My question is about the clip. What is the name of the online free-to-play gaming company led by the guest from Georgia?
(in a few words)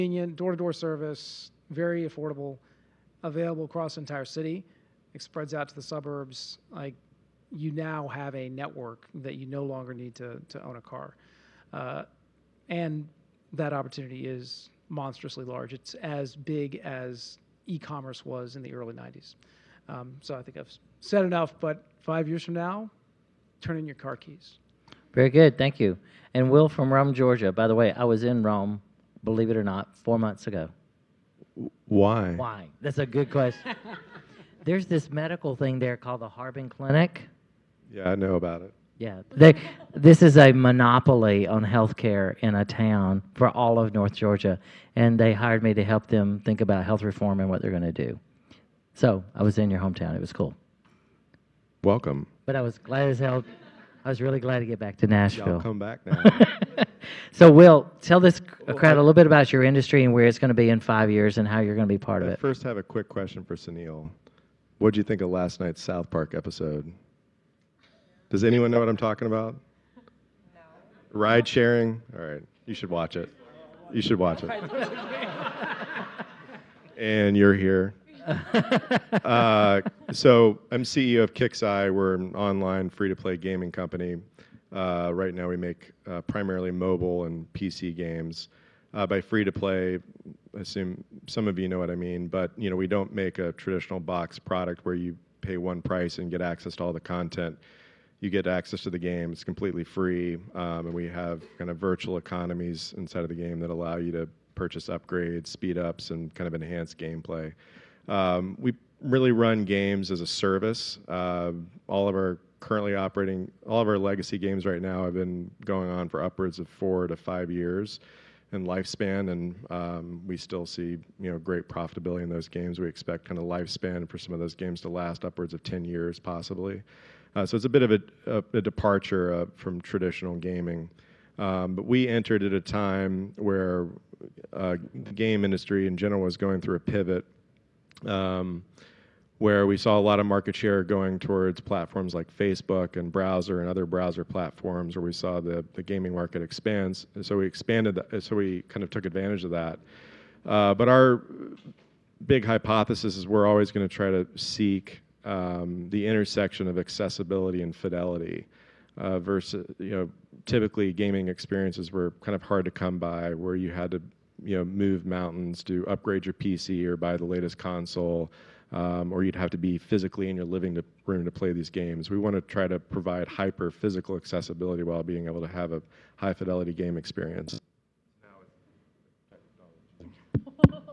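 Kixeye.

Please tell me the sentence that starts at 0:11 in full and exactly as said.
Uh, and that opportunity is monstrously large.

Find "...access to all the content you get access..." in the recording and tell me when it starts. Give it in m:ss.
1:36.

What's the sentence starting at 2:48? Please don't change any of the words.
Um, or you'd have to be physically in your living to, room to play these games.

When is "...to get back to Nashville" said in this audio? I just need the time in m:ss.
0:54.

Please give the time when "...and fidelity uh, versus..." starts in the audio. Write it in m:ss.
2:37.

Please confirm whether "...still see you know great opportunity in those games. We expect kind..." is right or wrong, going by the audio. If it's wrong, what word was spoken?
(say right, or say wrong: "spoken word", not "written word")
wrong: "profitability", not "opportunity".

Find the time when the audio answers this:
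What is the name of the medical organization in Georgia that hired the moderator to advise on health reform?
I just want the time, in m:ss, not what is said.
0:36.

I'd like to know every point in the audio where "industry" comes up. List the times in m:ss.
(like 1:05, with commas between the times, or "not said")
0:59, 2:15.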